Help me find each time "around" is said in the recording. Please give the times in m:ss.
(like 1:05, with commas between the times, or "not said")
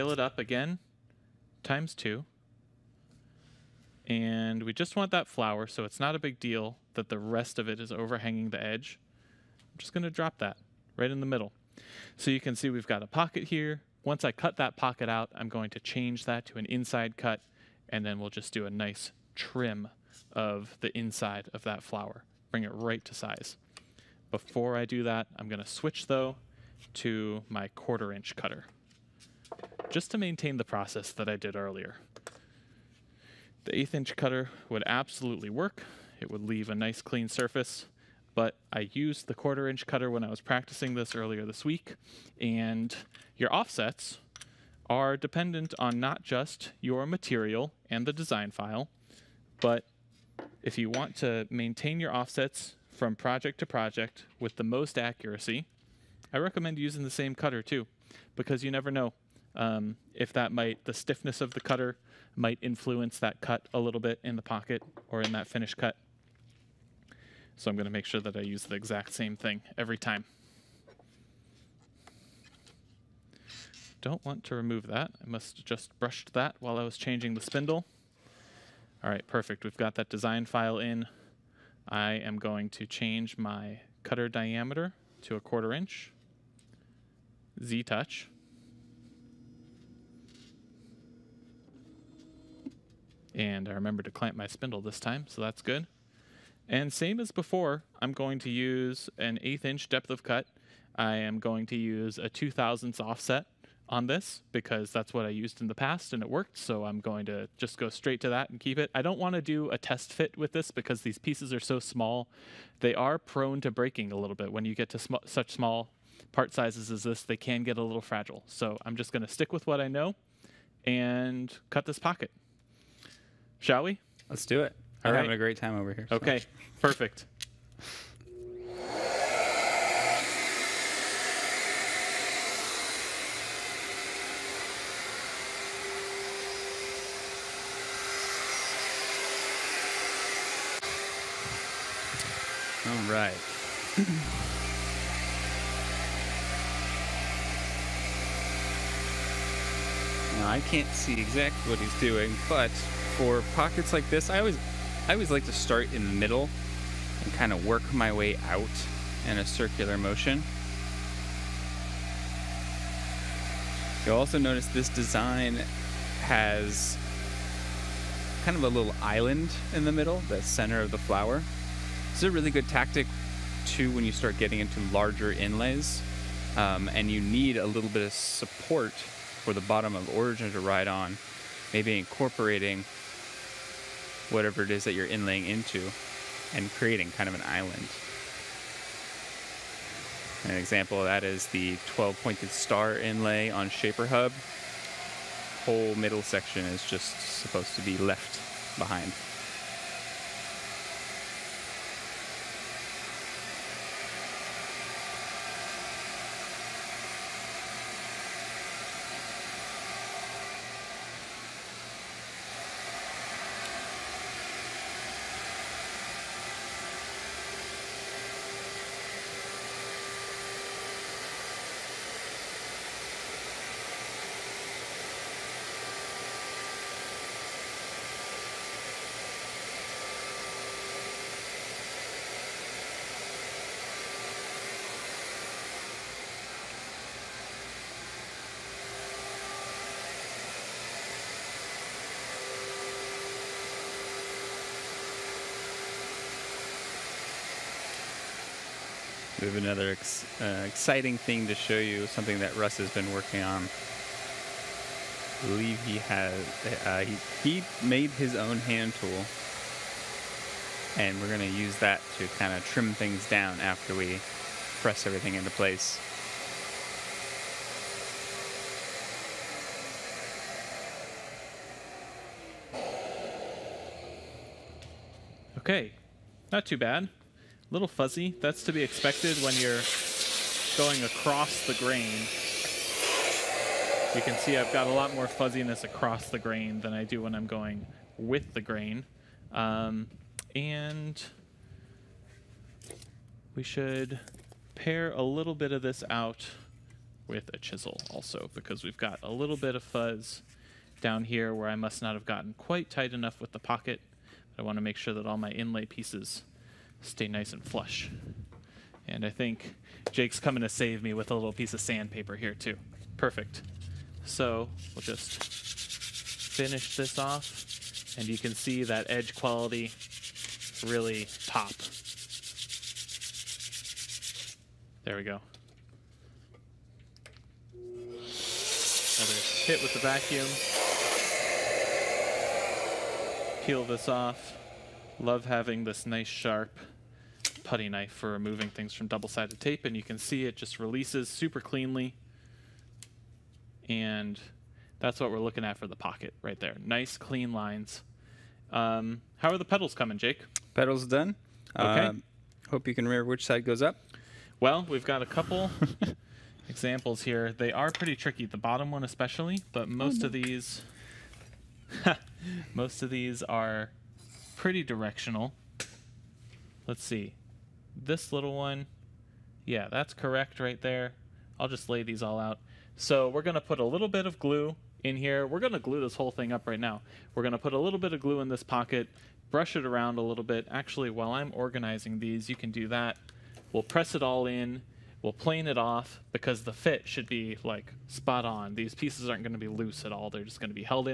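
6:19.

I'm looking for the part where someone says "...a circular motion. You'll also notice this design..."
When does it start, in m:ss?
2:39.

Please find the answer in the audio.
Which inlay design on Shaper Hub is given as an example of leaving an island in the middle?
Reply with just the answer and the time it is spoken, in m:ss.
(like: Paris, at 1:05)
12 pointed star, at 3:11.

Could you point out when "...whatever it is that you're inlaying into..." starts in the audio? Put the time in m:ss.
3:04.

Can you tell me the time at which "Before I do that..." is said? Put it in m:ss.
0:24.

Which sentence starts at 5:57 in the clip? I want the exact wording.
They are pretty tricky, the bottom one especially, but oh, most oh, of these...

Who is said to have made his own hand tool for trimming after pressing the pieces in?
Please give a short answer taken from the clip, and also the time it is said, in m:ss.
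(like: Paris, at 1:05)
Russ, at 4:12.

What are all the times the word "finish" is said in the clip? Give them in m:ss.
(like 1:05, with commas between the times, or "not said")
1:05, 5:15.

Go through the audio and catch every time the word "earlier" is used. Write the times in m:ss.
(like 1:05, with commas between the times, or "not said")
0:31, 0:41.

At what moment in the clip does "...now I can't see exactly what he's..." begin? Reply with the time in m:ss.
2:30.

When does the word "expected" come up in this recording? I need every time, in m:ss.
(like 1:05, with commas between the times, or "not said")
4:38.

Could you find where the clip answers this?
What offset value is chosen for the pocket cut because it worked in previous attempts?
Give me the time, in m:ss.
1:42.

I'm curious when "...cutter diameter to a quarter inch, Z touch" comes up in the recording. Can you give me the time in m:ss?
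1:24.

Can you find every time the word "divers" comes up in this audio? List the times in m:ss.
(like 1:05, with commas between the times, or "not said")
not said.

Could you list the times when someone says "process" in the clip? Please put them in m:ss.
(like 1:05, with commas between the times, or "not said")
0:30.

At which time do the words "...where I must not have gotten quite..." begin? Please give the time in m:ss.
5:01.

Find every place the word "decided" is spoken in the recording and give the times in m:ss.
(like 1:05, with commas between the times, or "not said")
not said.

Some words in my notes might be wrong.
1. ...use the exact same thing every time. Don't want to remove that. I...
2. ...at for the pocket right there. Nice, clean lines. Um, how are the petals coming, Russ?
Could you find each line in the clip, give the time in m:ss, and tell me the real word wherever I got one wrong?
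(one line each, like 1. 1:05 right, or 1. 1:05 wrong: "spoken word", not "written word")
1. 1:08 right
2. 5:45 wrong: "Jake", not "Russ".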